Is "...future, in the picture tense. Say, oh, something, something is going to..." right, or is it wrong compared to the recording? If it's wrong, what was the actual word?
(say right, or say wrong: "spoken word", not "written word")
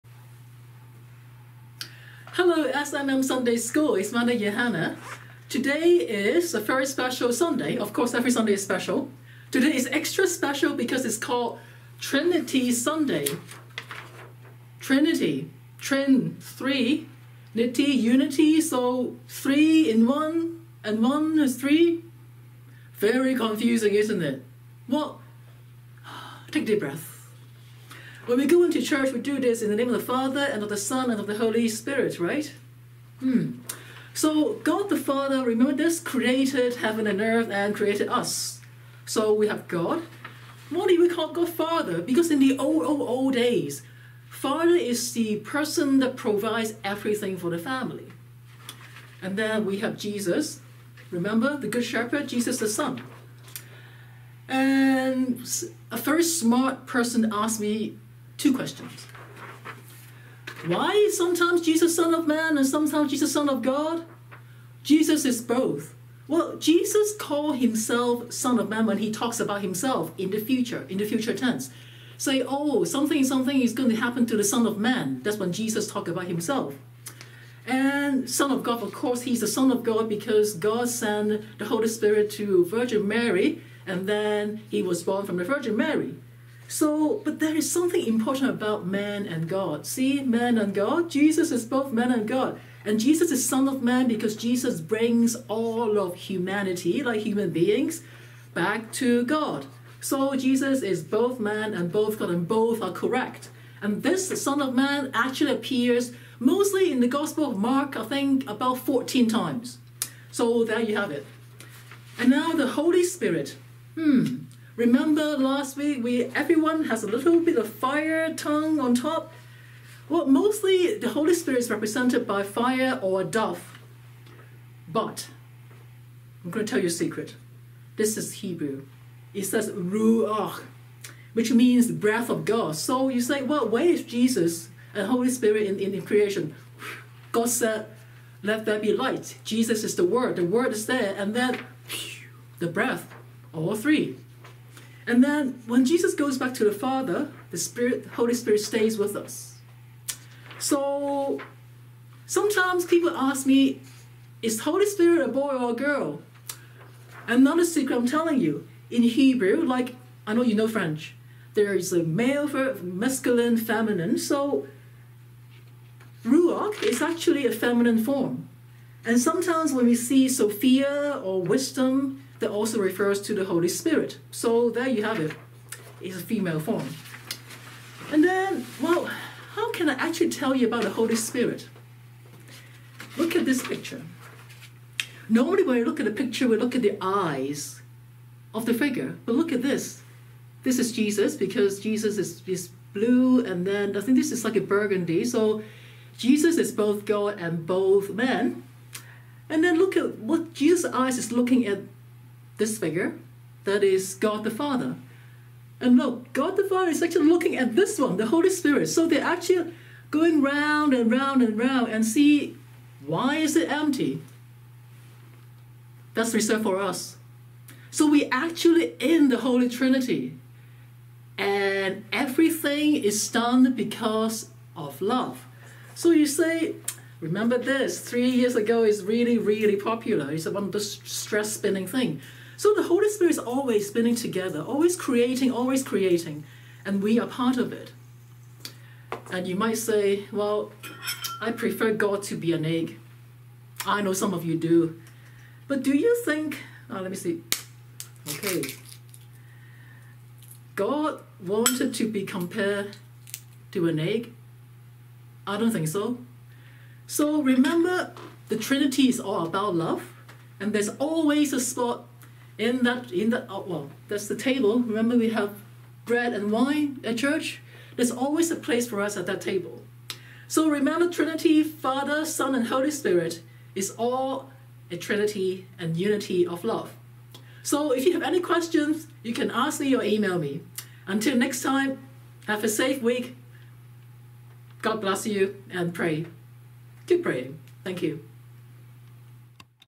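wrong: "future", not "picture".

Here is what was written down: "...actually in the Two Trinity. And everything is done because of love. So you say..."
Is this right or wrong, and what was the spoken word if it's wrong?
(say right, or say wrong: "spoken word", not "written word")
wrong: "Holy", not "Two".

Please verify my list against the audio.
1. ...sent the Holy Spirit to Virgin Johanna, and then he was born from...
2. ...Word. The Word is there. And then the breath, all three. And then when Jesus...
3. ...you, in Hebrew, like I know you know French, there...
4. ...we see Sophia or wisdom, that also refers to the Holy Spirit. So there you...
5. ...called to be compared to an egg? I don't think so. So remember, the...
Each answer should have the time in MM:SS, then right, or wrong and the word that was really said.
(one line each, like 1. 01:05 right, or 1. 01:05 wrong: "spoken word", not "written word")
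1. 01:20 wrong: "Mary", not "Johanna"
2. 02:20 right
3. 02:38 right
4. 02:49 right
5. 04:11 wrong: "wanted", not "called".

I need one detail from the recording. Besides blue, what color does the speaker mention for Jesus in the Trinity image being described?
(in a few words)
burgundy.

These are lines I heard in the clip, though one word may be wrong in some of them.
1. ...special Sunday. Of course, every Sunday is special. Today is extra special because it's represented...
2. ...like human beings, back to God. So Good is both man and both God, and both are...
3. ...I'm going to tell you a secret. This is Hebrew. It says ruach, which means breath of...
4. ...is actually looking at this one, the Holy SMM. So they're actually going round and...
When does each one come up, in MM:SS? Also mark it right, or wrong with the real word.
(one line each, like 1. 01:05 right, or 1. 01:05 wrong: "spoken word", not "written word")
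1. 00:06 wrong: "called", not "represented"
2. 01:37 wrong: "Jesus", not "Good"
3. 02:06 right
4. 03:26 wrong: "Spirit", not "SMM".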